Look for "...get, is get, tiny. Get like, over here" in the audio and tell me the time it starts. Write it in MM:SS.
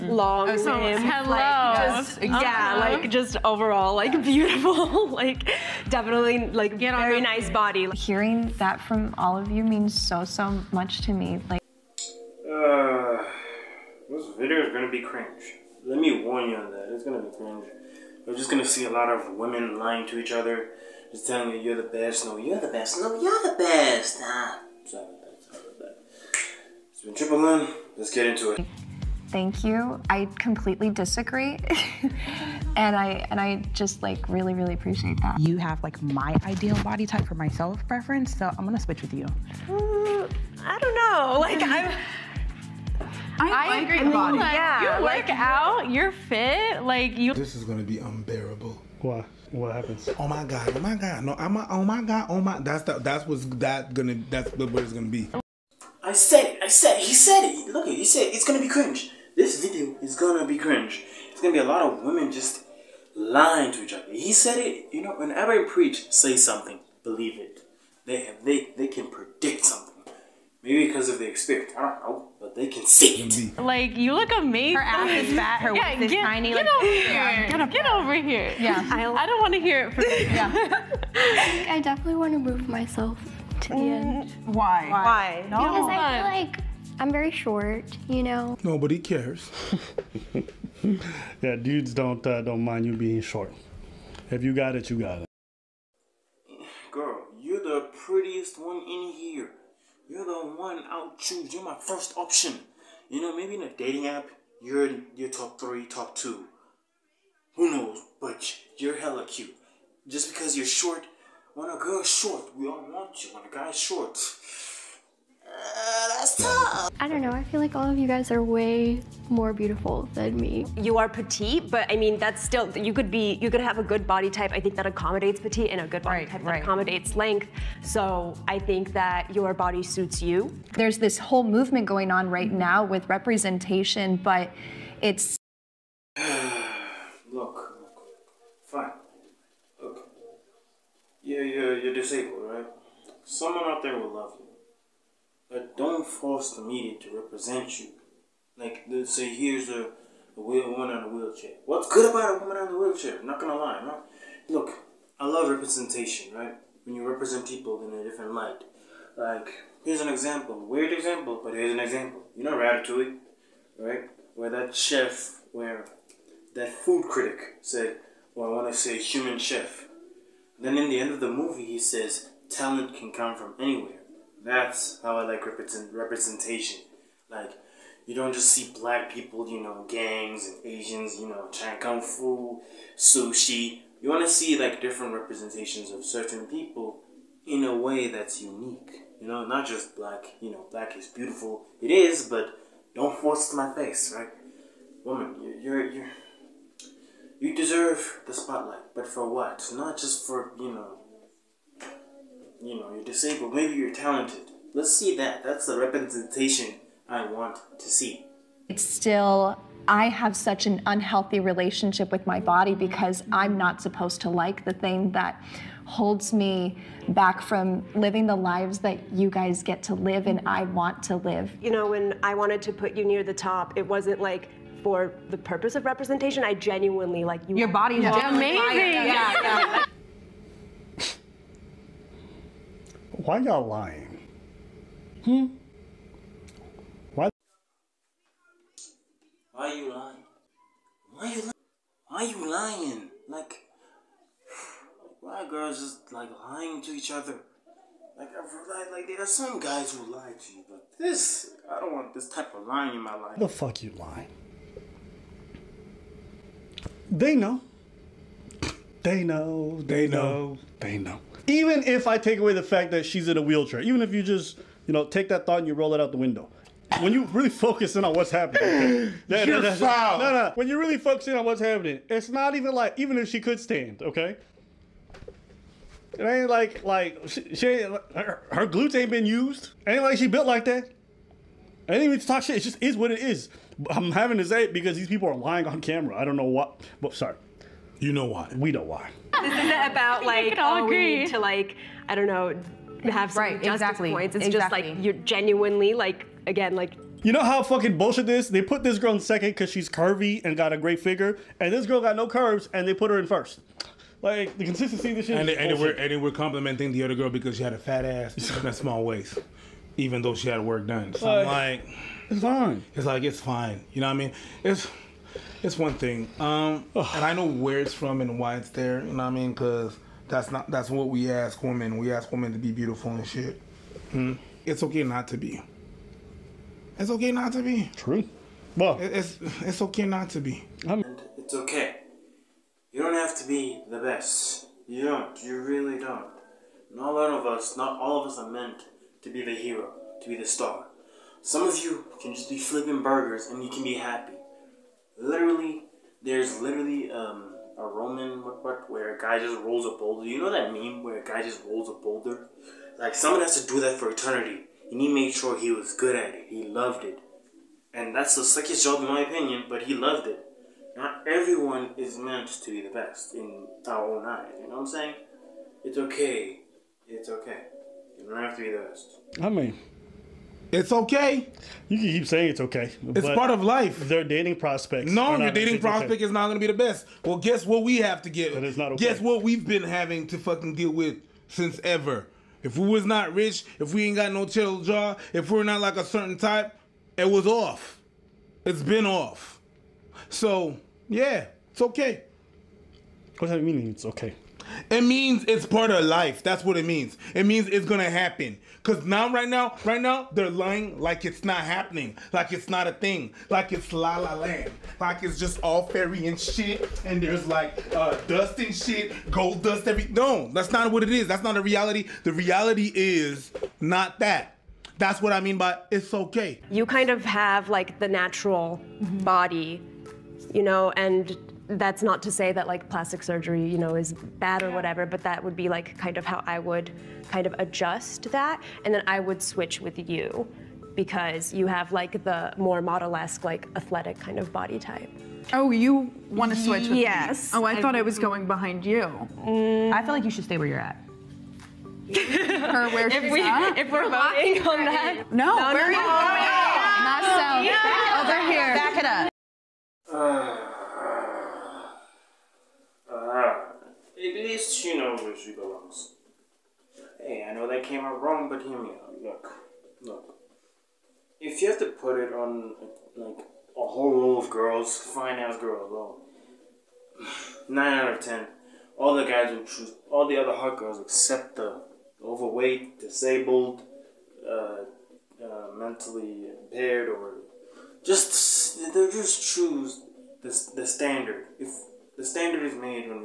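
01:15.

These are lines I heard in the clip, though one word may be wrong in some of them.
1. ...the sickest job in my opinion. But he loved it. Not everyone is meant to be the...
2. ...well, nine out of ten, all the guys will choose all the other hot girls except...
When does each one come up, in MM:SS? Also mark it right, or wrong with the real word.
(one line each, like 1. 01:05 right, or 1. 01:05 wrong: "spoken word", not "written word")
1. 05:58 right
2. 07:45 right.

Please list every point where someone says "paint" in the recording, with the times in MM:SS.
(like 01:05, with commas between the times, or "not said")
not said.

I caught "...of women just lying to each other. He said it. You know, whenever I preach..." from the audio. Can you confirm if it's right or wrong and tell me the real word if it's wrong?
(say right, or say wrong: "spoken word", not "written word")
right.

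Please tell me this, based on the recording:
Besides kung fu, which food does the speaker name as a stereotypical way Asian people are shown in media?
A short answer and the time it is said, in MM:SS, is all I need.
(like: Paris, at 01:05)
sushi, at 03:02.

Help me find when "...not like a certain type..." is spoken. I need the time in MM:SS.
06:25.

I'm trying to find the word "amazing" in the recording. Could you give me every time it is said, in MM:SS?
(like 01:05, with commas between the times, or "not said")
01:14, 03:48.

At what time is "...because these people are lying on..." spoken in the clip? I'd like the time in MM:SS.
04:44.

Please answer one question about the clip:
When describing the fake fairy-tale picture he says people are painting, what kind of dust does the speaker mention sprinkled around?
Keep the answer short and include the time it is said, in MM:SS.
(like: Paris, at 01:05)
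gold dust, at 06:49.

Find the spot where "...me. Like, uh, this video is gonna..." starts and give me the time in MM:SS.
00:11.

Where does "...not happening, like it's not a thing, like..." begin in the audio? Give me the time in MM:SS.
06:41.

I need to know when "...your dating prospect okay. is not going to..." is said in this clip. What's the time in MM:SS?
06:15.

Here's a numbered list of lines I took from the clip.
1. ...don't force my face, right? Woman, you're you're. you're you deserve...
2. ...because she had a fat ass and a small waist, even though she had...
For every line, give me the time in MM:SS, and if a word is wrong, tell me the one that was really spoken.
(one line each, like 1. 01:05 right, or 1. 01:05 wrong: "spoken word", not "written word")
1. 03:12 right
2. 05:07 right.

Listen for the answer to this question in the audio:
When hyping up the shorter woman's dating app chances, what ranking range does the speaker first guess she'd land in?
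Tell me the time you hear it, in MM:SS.
01:45.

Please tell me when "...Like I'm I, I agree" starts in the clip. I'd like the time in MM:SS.
00:43.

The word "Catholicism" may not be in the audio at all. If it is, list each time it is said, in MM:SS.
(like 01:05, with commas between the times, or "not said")
not said.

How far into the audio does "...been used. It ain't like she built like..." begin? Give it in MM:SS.
04:39.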